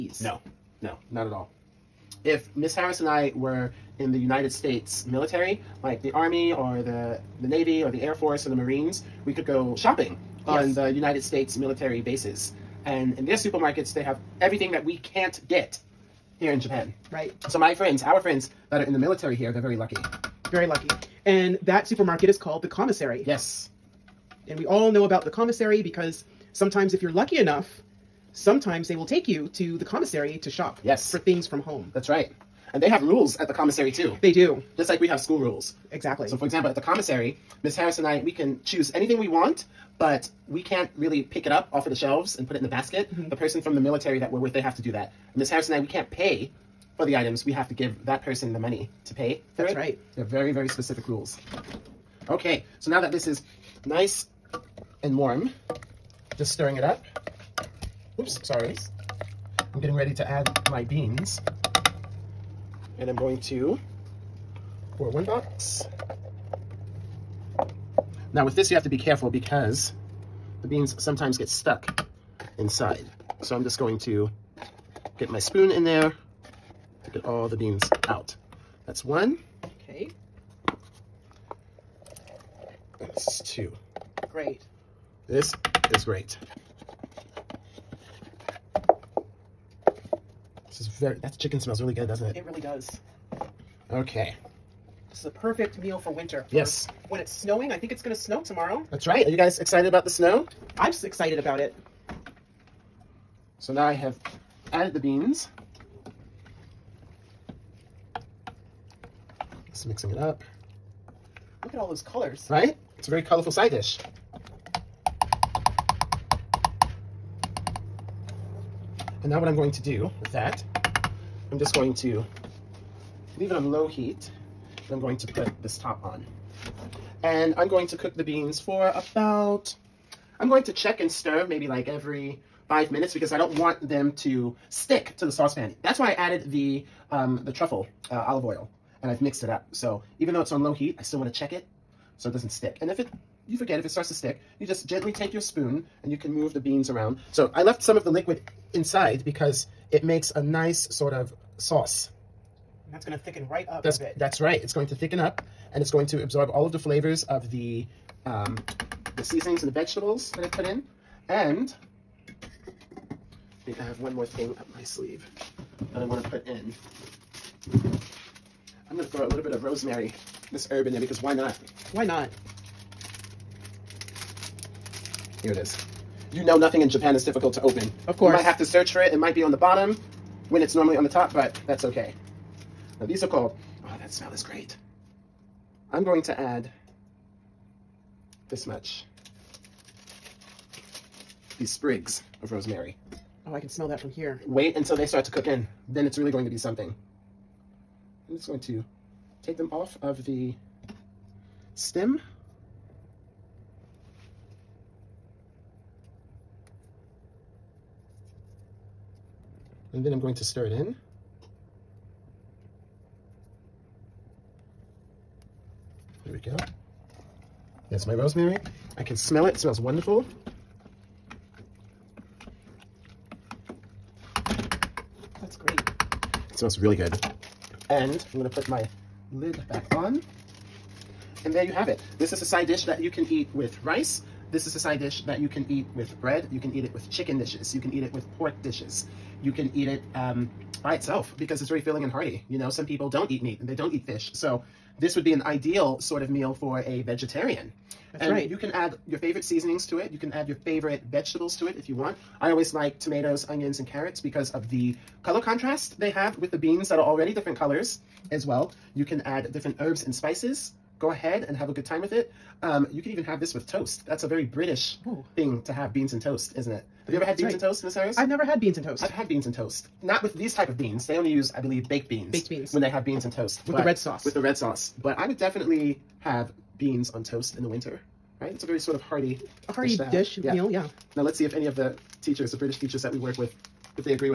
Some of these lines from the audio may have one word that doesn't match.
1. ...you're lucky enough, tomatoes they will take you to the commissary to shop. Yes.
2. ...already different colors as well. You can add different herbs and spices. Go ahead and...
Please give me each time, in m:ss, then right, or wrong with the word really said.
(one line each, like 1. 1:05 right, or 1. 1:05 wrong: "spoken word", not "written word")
1. 0:27 wrong: "sometimes", not "tomatoes"
2. 4:17 right.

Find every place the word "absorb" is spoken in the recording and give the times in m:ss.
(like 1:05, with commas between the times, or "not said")
2:36.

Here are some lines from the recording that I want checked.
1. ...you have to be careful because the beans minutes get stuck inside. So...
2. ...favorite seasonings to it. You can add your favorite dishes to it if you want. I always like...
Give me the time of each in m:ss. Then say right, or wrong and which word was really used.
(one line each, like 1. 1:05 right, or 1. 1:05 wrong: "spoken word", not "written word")
1. 1:08 wrong: "sometimes", not "minutes"
2. 4:09 wrong: "vegetables", not "dishes".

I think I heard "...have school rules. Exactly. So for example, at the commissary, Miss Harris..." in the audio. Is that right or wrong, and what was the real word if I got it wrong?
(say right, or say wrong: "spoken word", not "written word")
right.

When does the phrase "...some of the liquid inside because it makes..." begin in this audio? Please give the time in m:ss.
2:27.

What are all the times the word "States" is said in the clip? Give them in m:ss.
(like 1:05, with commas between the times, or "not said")
0:04, 0:11.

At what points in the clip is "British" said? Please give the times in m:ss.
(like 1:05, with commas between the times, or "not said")
4:24, 4:42.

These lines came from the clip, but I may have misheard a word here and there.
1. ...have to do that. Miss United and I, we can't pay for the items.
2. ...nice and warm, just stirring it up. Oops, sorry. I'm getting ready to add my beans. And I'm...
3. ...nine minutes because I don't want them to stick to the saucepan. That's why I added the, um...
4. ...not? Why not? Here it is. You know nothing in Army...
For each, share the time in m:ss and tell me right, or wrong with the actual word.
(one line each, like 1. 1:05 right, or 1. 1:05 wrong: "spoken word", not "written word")
1. 0:44 wrong: "Harris", not "United"
2. 0:53 right
3. 2:12 wrong: "five", not "nine"
4. 2:51 wrong: "Japan", not "Army".